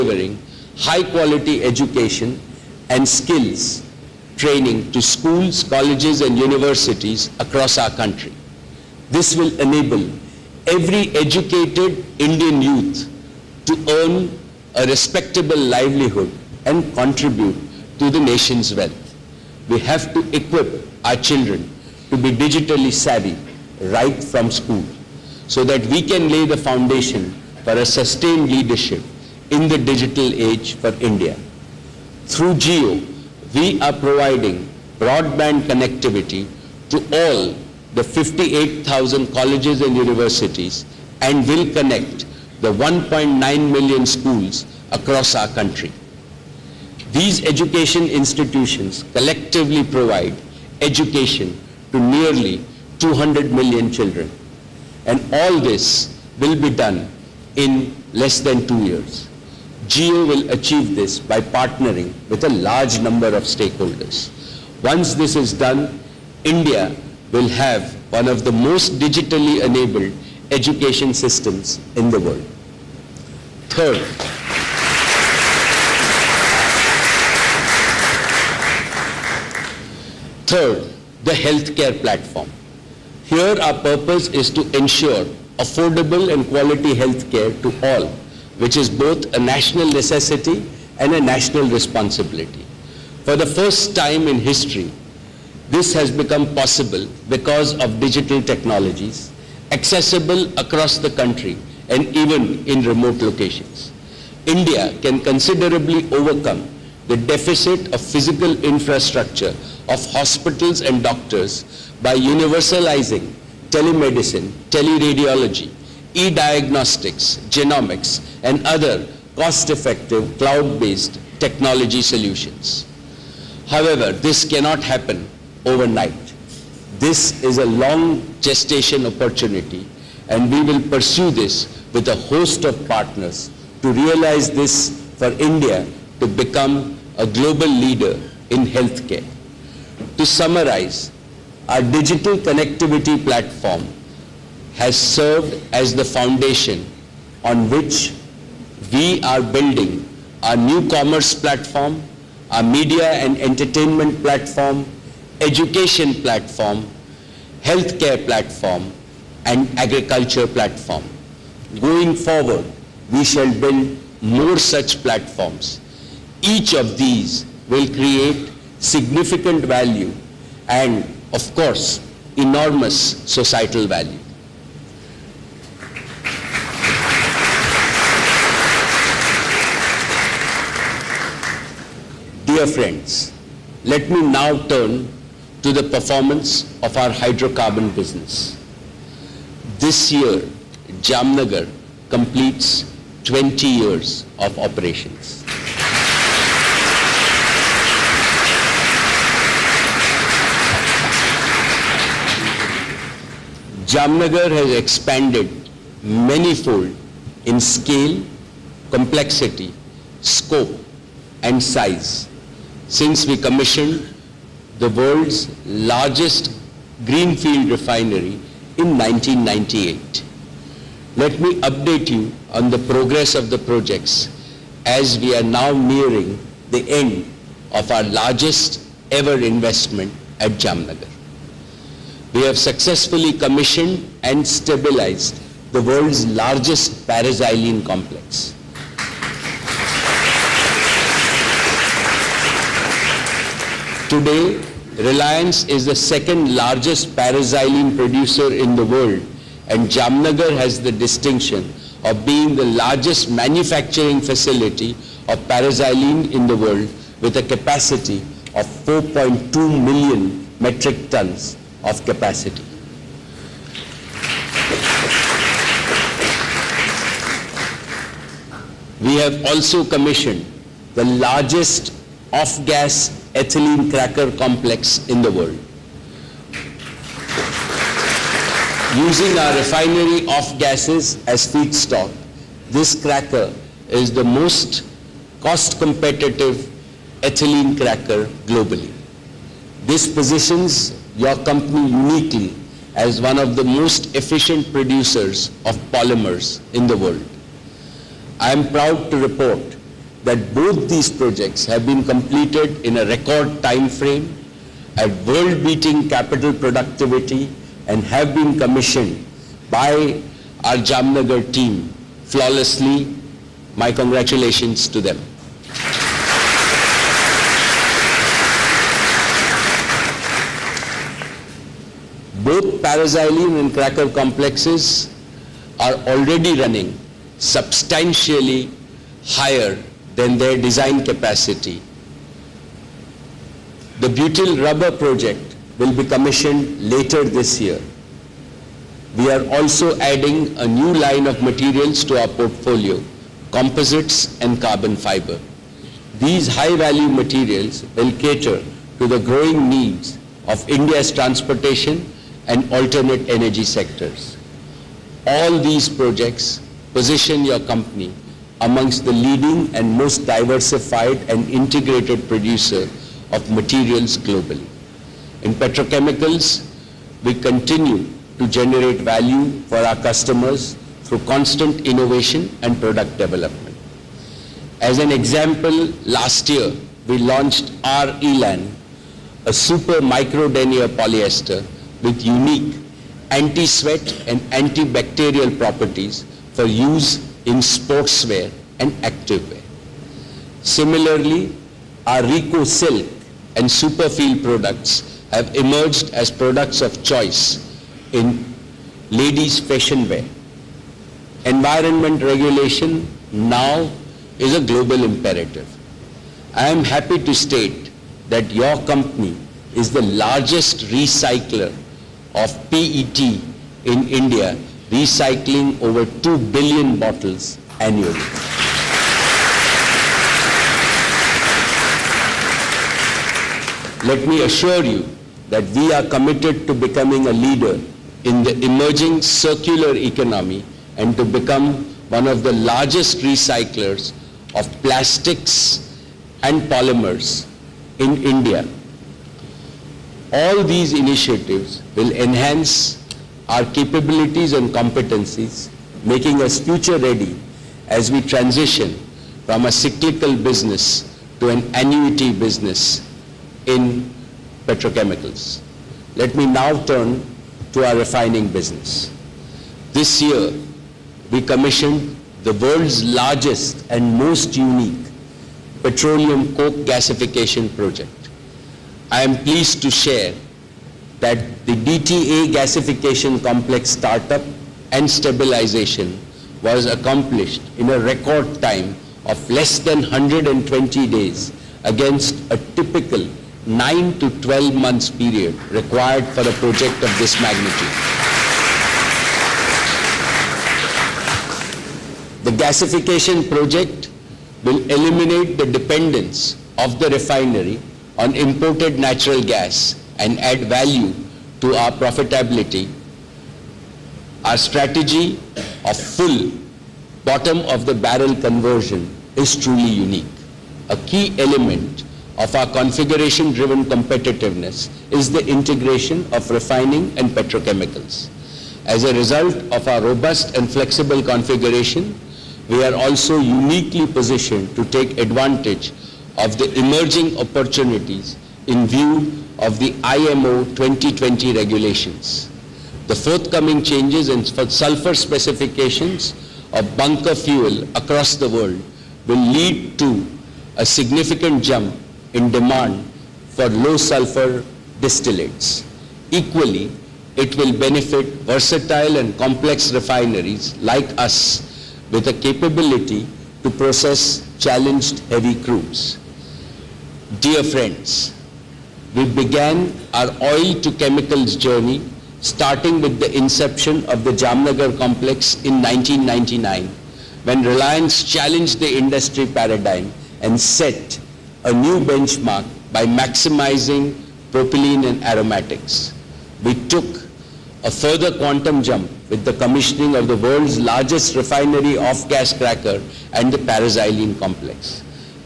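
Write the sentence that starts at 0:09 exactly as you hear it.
This will enable every educated Indian youth to earn a respectable livelihood and contribute to the nation's wealth.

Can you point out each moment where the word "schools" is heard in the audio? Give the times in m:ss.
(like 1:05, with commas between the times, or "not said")
0:05, 0:24, 0:44.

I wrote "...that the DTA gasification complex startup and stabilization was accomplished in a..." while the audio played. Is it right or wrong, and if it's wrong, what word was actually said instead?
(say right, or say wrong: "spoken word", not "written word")
right.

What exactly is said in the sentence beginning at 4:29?
We have also commissioned the largest off-gas ethylene cracker complex in the world.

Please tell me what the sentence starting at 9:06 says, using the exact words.
Equally, it will benefit versatile and complex refineries like us with a capability to process challenged heavy crudes.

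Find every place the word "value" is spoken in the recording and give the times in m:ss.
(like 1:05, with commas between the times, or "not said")
2:49, 2:53, 5:46, 6:08, 8:20.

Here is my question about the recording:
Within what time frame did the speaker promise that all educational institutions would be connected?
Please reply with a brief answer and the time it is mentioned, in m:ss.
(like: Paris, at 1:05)
less than two years, at 0:58.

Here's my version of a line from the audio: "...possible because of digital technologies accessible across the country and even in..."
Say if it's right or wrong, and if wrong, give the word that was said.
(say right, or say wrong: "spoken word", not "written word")
right.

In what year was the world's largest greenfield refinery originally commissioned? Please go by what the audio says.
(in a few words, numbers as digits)
1998.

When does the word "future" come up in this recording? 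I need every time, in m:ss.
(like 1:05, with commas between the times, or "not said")
7:26.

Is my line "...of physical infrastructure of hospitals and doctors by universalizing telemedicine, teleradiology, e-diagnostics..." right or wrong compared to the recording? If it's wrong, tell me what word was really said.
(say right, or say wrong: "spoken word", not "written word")
right.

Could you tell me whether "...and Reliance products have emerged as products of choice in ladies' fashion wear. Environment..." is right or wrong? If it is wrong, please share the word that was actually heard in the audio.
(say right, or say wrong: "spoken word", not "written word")
wrong: "Superfeel", not "Reliance".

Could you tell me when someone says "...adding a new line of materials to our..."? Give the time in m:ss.
5:40.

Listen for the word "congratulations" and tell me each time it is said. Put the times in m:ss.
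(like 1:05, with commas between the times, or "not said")
5:13.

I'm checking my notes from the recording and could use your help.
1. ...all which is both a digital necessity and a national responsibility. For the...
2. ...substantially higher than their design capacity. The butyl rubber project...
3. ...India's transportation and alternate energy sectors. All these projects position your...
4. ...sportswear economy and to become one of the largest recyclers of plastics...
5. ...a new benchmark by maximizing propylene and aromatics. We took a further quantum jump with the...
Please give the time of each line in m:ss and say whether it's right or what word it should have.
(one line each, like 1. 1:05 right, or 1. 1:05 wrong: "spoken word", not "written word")
1. 1:27 wrong: "national", not "digital"
2. 5:27 right
3. 5:50 right
4. 7:09 wrong: "circular", not "sportswear"
5. 9:31 right.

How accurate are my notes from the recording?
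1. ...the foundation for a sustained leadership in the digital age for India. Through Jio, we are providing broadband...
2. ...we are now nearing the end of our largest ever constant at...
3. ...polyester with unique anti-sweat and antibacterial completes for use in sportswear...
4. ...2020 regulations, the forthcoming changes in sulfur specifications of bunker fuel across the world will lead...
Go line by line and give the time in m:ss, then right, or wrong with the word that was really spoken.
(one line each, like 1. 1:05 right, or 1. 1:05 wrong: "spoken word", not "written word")
1. 0:26 right
2. 3:45 wrong: "investment", not "constant"
3. 6:20 wrong: "properties", not "completes"
4. 8:50 right.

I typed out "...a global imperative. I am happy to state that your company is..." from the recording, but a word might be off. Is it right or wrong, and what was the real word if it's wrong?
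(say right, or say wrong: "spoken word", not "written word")
right.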